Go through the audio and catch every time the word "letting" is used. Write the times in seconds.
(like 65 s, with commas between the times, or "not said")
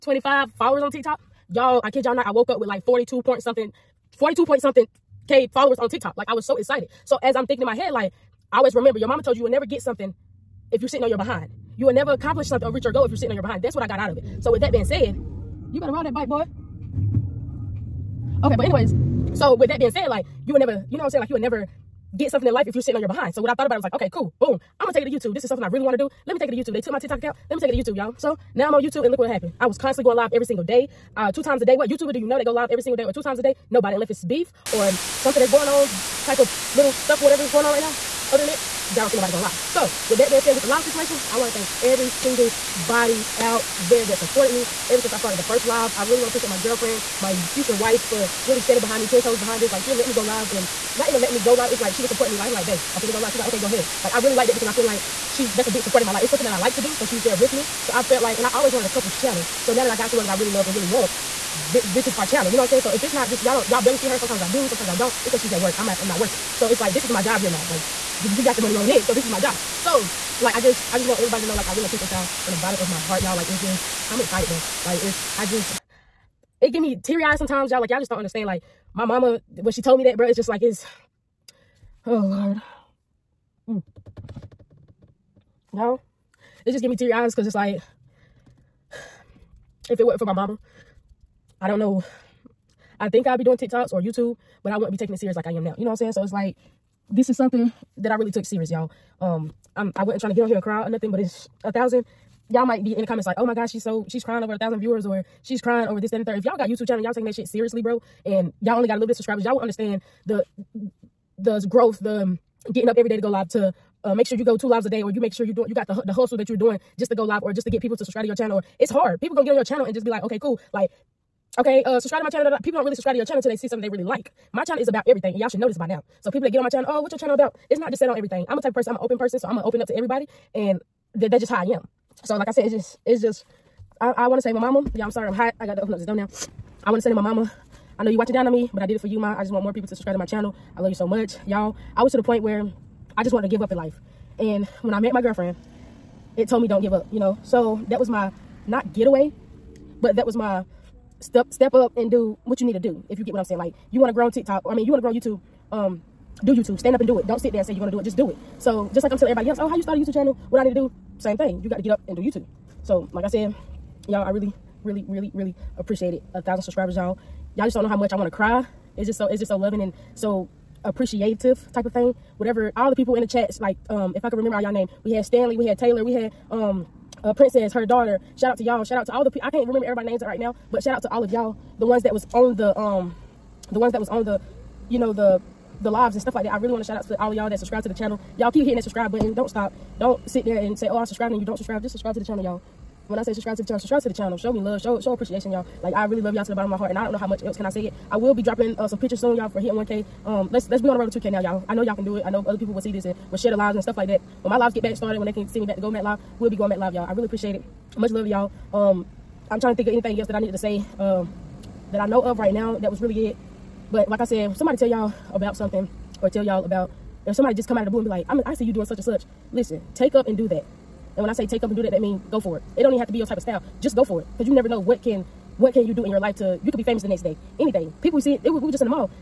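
51 s.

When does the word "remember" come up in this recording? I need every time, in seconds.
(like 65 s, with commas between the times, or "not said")
8 s, 174 s, 179 s.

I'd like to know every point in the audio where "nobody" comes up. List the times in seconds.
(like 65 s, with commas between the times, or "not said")
33 s, 39 s.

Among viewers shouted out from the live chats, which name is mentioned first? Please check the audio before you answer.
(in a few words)
Stanley.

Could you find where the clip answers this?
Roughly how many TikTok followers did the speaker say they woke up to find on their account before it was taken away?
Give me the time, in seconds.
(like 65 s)
4 s.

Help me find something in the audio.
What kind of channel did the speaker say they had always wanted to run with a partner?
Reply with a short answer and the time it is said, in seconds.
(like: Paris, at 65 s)
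couples channel, at 58 s.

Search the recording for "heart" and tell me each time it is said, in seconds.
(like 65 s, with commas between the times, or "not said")
72 s, 196 s.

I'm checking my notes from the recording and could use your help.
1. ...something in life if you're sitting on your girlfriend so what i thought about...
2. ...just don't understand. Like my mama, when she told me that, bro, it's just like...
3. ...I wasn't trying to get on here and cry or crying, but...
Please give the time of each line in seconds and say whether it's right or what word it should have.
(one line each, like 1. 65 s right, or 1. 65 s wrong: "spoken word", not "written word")
1. 22 s wrong: "behind", not "girlfriend"
2. 77 s right
3. 99 s wrong: "nothing", not "crying".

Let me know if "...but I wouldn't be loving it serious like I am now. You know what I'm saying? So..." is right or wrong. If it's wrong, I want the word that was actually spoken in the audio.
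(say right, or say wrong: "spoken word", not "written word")
wrong: "taking", not "loving".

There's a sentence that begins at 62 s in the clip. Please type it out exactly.
So if it's not just y'all don't y'all barely see her.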